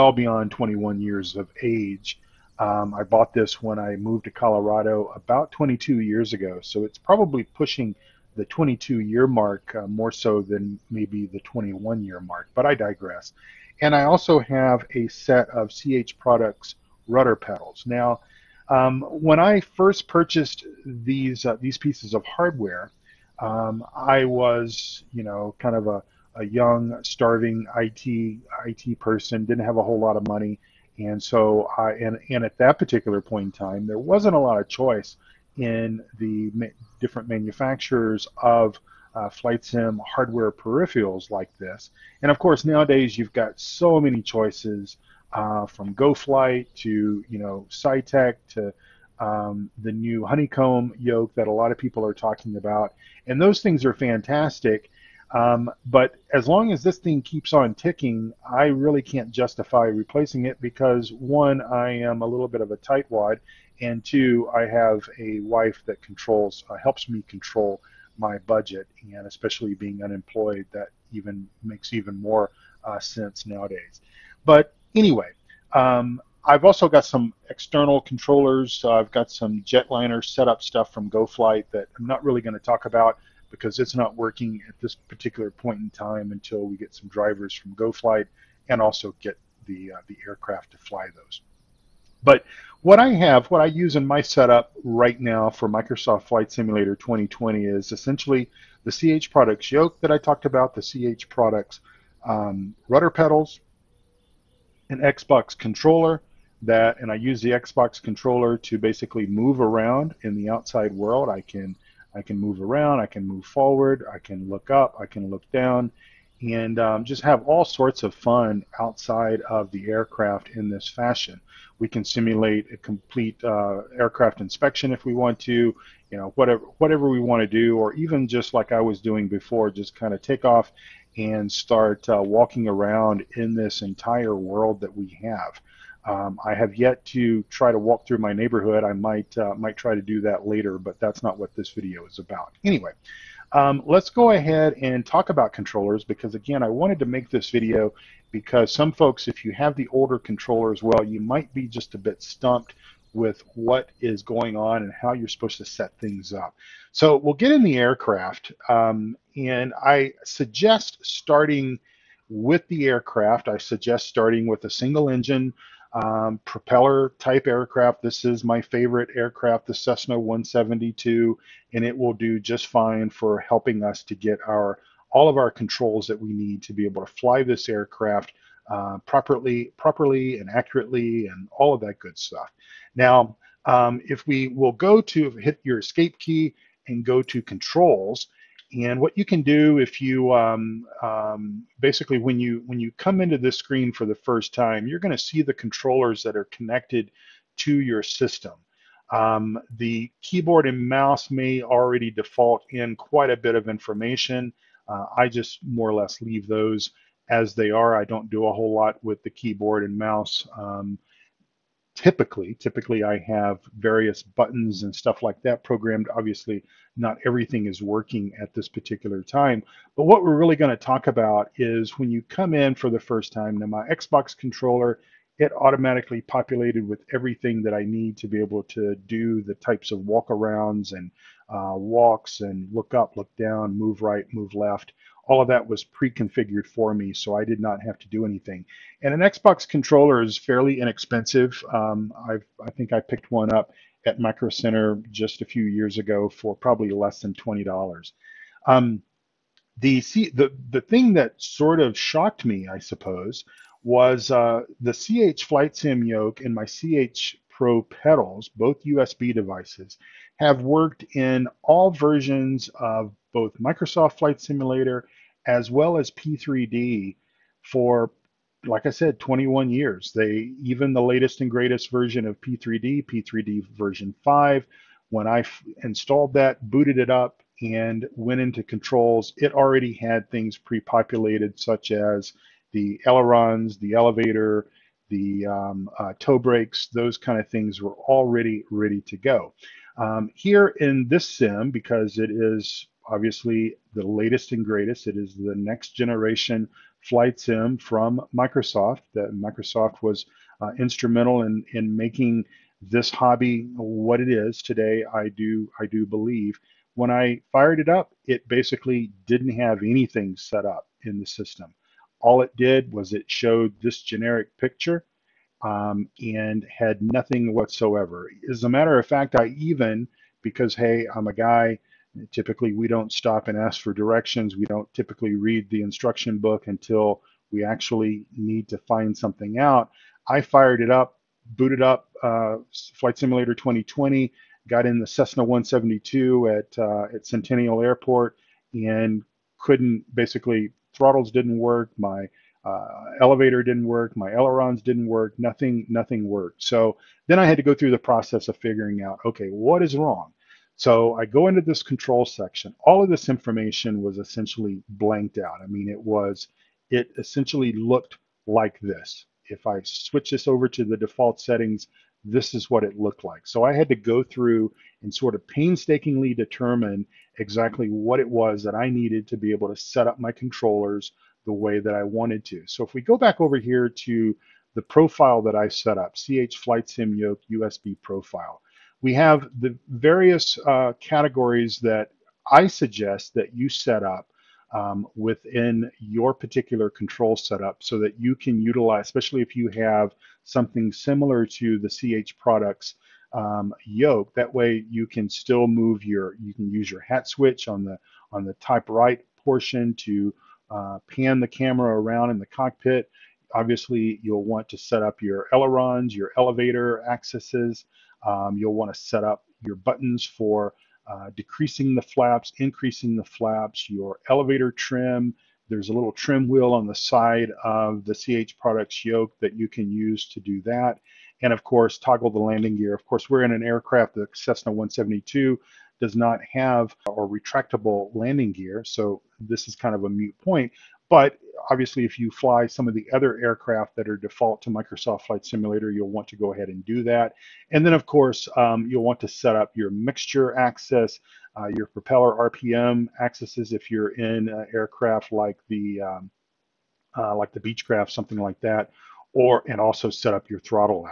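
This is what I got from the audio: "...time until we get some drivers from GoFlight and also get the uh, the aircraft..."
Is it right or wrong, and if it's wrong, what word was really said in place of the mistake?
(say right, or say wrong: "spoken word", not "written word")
right.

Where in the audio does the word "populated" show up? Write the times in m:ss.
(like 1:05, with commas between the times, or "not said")
3:46, 4:40.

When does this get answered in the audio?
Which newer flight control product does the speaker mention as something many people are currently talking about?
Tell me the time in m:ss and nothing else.
0:50.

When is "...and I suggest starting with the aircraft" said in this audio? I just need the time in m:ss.
2:39.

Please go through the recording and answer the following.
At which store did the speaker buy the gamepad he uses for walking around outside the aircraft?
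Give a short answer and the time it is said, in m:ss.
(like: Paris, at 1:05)
Micro Center, at 4:04.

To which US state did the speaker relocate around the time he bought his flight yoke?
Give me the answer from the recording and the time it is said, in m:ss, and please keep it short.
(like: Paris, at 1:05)
Colorado, at 0:04.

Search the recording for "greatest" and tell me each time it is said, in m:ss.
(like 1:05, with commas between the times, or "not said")
4:31, 4:54.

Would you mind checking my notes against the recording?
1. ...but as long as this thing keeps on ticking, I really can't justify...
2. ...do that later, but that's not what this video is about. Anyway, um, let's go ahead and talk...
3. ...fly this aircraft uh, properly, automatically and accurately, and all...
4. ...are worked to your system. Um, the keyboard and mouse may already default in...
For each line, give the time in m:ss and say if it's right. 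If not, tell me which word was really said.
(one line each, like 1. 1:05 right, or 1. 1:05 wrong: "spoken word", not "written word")
1. 0:55 right
2. 2:20 right
3. 2:57 wrong: "properly", not "automatically"
4. 3:16 wrong: "connected", not "worked".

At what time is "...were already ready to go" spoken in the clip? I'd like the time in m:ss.
4:47.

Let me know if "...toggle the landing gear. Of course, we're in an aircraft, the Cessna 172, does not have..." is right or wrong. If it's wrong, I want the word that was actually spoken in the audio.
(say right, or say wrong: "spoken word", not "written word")
right.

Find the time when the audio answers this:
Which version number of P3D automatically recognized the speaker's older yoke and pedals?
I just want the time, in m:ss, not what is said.
4:33.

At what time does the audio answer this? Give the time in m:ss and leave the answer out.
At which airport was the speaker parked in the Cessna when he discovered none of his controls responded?
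5:37.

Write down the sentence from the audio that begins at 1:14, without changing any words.
But anyway, um, I've also got some external controllers.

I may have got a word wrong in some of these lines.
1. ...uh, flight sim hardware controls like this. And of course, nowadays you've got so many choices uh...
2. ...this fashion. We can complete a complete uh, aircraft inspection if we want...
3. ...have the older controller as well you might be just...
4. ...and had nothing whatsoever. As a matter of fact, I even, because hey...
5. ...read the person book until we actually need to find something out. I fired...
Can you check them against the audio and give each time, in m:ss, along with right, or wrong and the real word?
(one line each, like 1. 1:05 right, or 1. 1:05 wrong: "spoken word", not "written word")
1. 0:39 wrong: "peripherals", not "controls"
2. 2:00 wrong: "simulate", not "complete"
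3. 2:29 right
4. 5:16 right
5. 5:25 wrong: "instruction", not "person".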